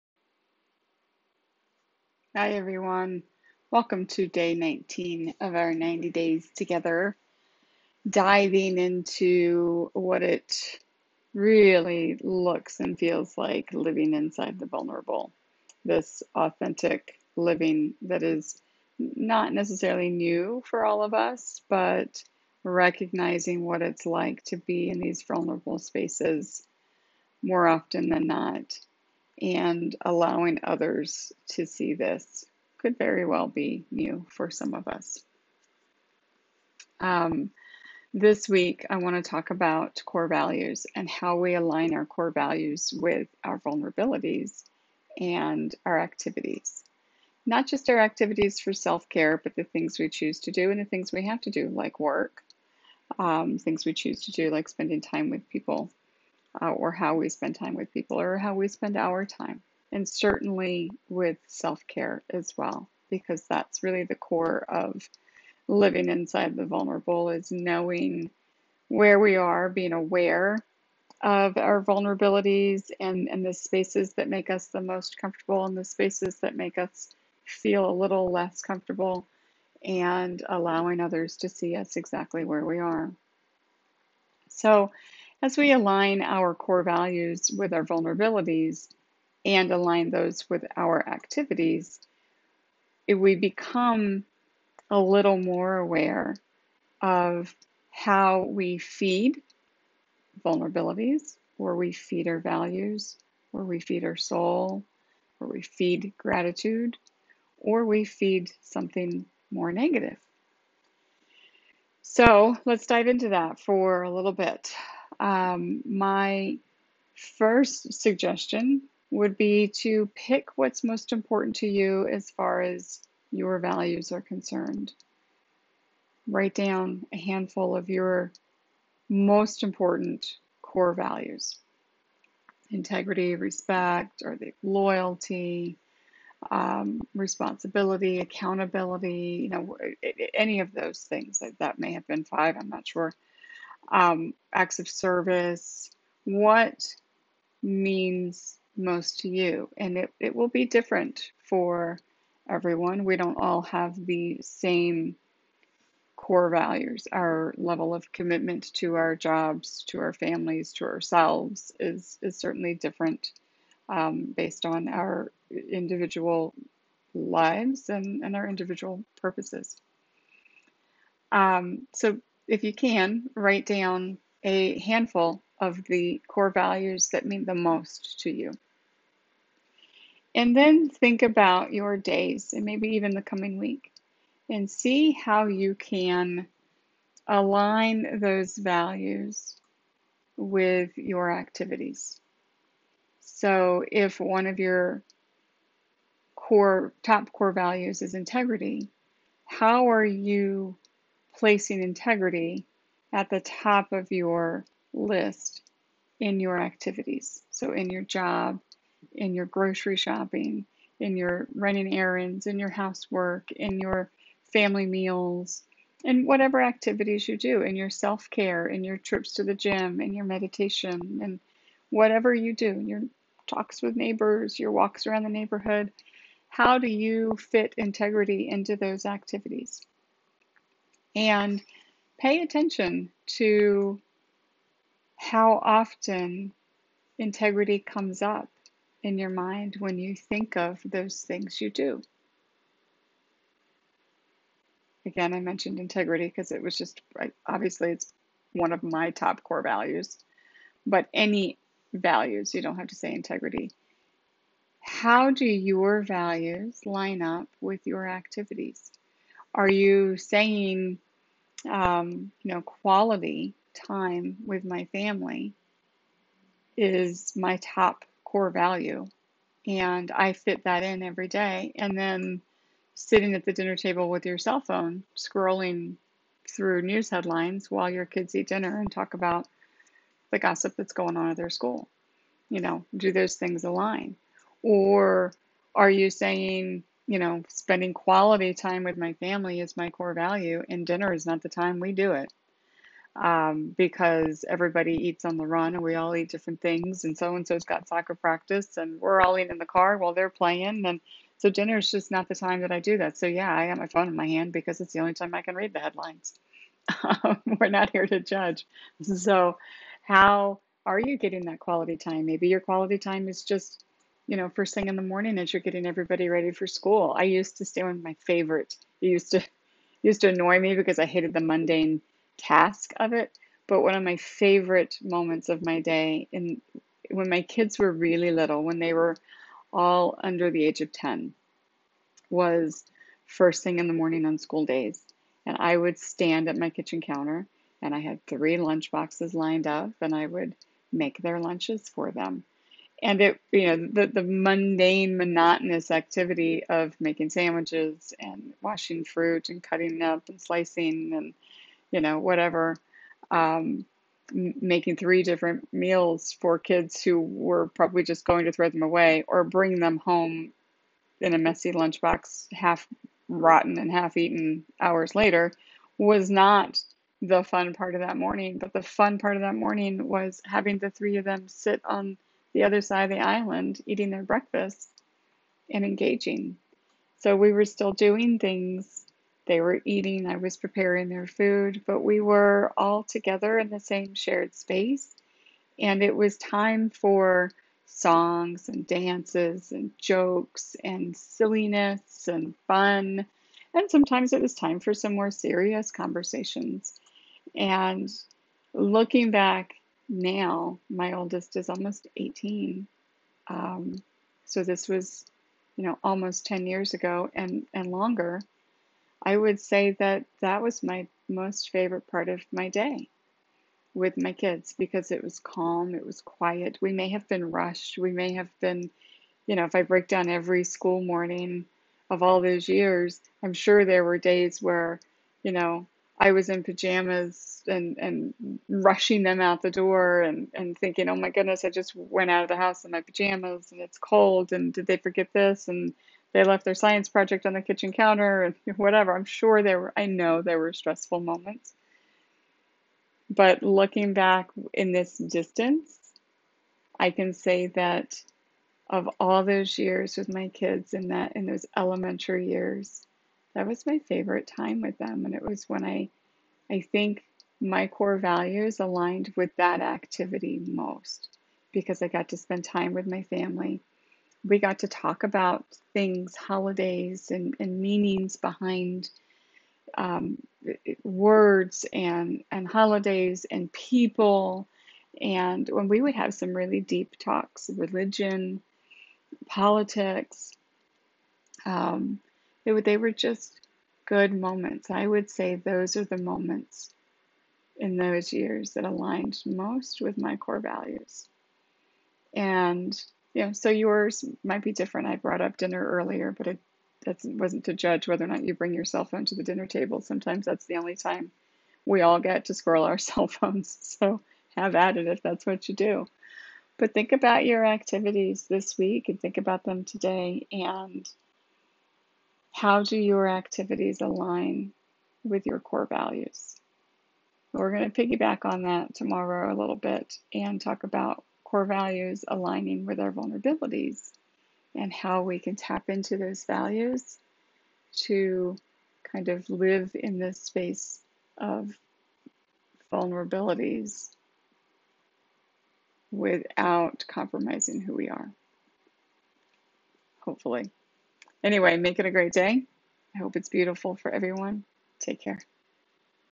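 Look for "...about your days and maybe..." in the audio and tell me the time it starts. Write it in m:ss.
3:01.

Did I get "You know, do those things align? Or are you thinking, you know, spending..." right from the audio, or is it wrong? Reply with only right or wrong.
wrong.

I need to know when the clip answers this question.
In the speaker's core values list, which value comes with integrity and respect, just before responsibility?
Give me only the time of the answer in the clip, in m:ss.
2:14.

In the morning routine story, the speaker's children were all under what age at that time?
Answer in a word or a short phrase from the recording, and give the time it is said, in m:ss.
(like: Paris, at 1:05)
10, at 5:30.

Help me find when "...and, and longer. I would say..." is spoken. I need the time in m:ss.
6:47.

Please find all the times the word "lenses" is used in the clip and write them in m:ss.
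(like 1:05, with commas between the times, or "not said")
not said.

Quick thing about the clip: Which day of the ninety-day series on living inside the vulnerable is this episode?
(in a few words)
19.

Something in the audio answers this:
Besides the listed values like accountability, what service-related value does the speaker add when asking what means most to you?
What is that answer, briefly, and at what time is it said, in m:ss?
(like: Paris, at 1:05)
acts of service, at 2:24.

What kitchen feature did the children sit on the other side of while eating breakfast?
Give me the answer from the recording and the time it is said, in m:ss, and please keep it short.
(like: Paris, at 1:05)
the island, at 6:13.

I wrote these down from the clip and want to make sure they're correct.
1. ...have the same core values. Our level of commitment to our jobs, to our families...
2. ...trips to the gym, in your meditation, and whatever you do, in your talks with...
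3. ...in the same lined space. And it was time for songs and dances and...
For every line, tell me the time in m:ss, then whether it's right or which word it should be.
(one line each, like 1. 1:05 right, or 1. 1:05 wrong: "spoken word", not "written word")
1. 2:33 right
2. 3:38 right
3. 6:23 wrong: "shared", not "lined".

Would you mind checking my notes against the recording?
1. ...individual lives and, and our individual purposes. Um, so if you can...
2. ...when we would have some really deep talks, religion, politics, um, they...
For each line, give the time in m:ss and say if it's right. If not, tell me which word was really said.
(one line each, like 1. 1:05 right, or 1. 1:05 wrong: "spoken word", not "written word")
1. 2:45 right
2. 7:55 right.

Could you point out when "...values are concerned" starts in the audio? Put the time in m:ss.
2:03.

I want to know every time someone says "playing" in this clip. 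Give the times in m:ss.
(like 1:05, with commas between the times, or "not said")
5:00.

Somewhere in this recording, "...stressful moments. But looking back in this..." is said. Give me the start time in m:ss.
7:20.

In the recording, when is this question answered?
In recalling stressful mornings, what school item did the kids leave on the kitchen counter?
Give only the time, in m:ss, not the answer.
7:16.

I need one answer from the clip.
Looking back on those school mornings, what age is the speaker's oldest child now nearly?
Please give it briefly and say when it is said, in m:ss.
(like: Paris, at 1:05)
18, at 6:42.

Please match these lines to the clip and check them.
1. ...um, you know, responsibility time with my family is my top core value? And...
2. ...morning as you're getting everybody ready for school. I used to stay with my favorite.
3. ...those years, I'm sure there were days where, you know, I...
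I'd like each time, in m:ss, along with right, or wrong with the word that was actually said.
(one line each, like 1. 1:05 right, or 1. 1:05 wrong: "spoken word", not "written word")
1. 4:21 wrong: "quality", not "responsibility"
2. 5:15 right
3. 7:02 right.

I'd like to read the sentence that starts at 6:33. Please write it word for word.
And sometimes it was time for some more serious conversations.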